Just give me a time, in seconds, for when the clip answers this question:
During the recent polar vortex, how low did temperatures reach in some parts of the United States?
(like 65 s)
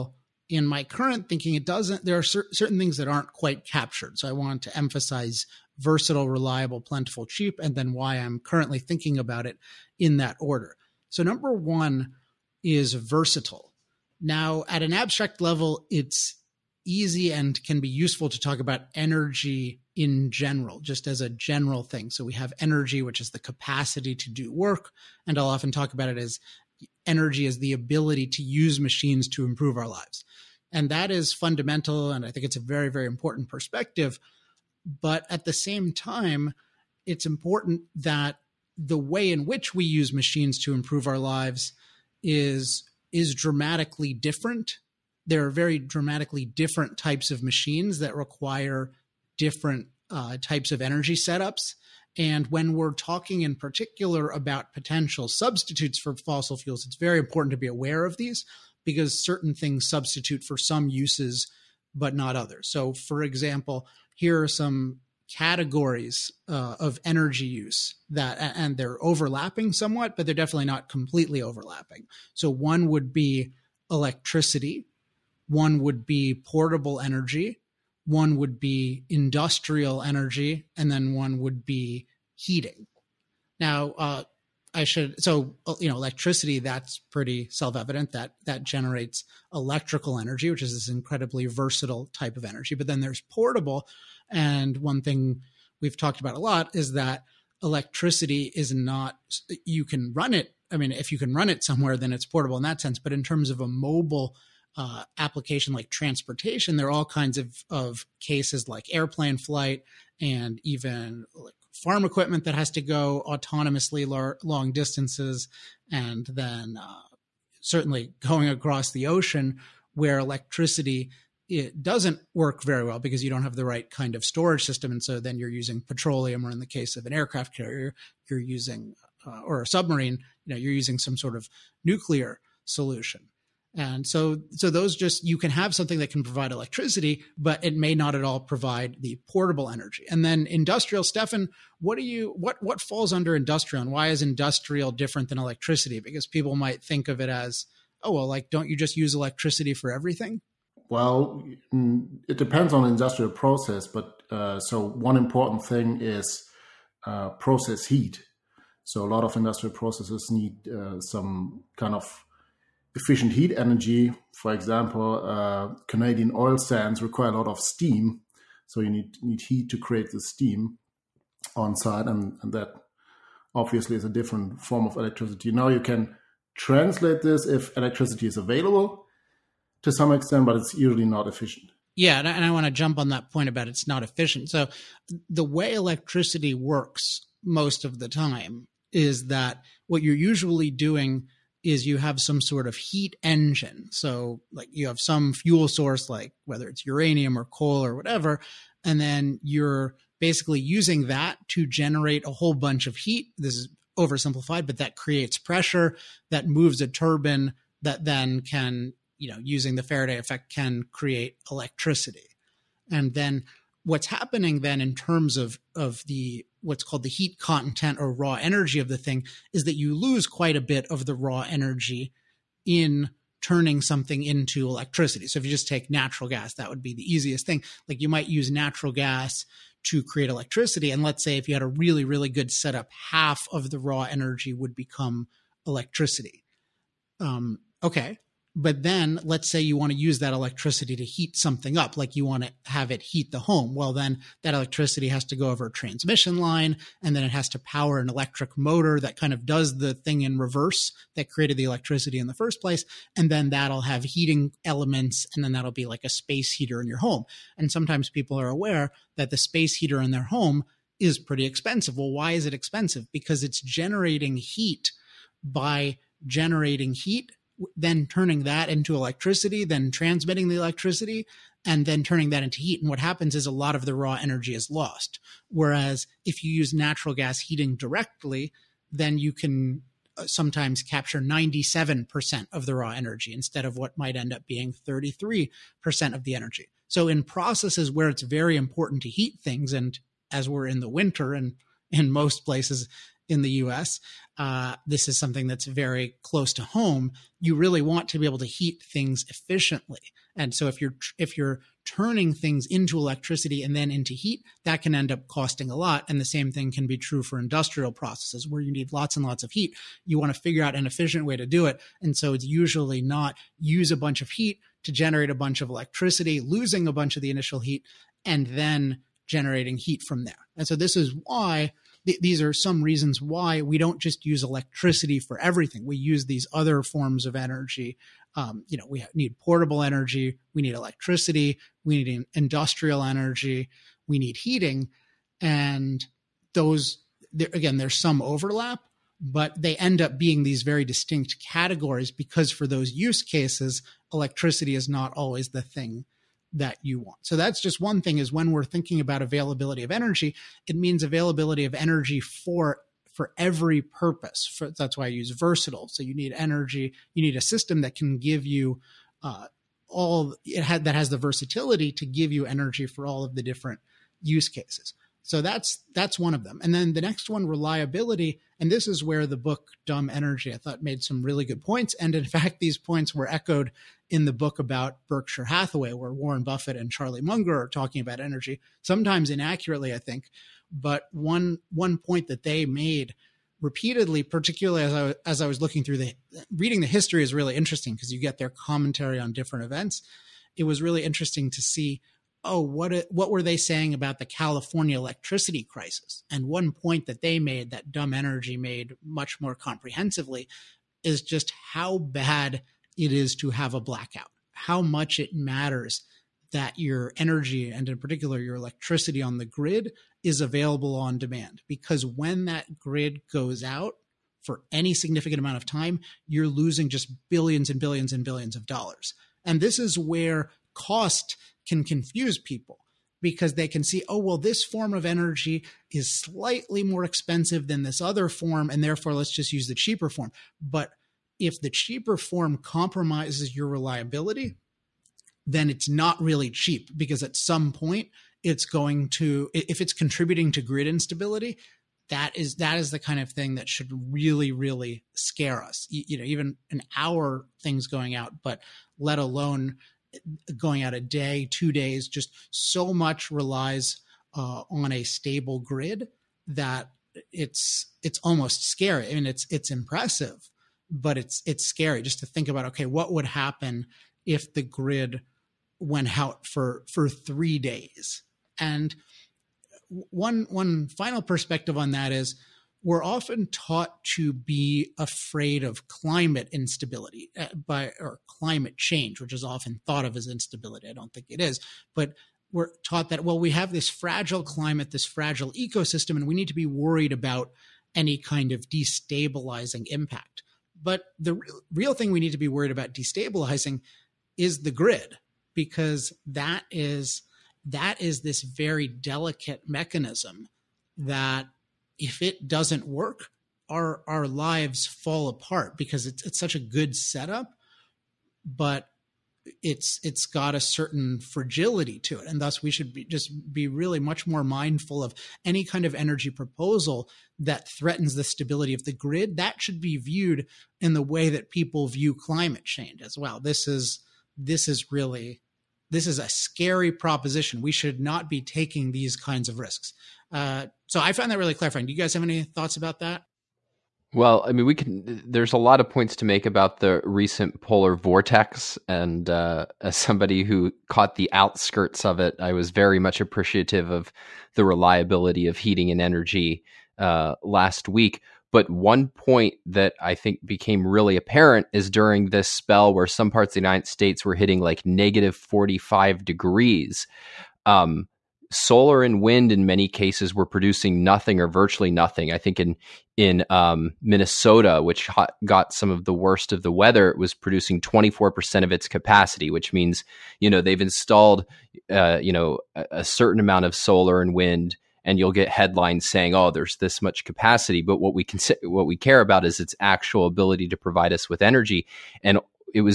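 554 s.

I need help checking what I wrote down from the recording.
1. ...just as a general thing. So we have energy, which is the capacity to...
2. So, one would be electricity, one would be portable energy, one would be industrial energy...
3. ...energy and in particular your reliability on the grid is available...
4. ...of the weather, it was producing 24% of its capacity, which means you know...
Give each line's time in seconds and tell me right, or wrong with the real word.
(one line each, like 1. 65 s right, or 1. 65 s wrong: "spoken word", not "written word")
1. 20 s right
2. 72 s right
3. 407 s wrong: "electricity", not "reliability"
4. 566 s right.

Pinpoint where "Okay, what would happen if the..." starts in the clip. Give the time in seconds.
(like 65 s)
462 s.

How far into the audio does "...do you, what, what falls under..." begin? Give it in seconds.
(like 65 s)
141 s.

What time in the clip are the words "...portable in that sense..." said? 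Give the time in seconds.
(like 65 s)
102 s.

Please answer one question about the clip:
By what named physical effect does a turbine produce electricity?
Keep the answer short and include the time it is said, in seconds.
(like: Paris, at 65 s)
Faraday effect, at 209 s.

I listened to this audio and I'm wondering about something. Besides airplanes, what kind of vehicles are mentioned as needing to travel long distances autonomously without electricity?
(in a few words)
farm equipment.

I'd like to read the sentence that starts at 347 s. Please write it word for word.
So that's just one thing is when we're thinking about availability of energy, it means availability of energy for for every purpose.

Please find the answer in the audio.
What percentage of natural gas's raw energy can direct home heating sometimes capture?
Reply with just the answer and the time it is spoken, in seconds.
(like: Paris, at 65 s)
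97%, at 281 s.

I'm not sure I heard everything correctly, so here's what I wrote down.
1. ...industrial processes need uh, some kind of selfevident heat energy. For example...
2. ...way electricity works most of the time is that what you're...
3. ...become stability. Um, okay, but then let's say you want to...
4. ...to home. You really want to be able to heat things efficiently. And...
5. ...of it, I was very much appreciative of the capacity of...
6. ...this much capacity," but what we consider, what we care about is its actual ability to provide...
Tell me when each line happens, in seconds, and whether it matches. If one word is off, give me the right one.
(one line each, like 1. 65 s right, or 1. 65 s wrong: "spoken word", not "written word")
1. 159 s wrong: "efficient", not "selfevident"
2. 185 s right
3. 234 s wrong: "electricity", not "stability"
4. 296 s right
5. 542 s wrong: "reliability", not "capacity"
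6. 576 s right.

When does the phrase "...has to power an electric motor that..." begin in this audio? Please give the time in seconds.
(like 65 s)
247 s.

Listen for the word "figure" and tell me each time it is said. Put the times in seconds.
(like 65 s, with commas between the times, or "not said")
310 s.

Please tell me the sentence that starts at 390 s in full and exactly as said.
It was really interesting to see oh, what what were they saying about the California electricity crisis?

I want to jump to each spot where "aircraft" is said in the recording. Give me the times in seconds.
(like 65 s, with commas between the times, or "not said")
127 s.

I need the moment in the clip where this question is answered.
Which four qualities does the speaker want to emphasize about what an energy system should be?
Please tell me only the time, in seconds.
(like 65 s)
5 s.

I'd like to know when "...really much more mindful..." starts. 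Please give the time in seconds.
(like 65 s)
513 s.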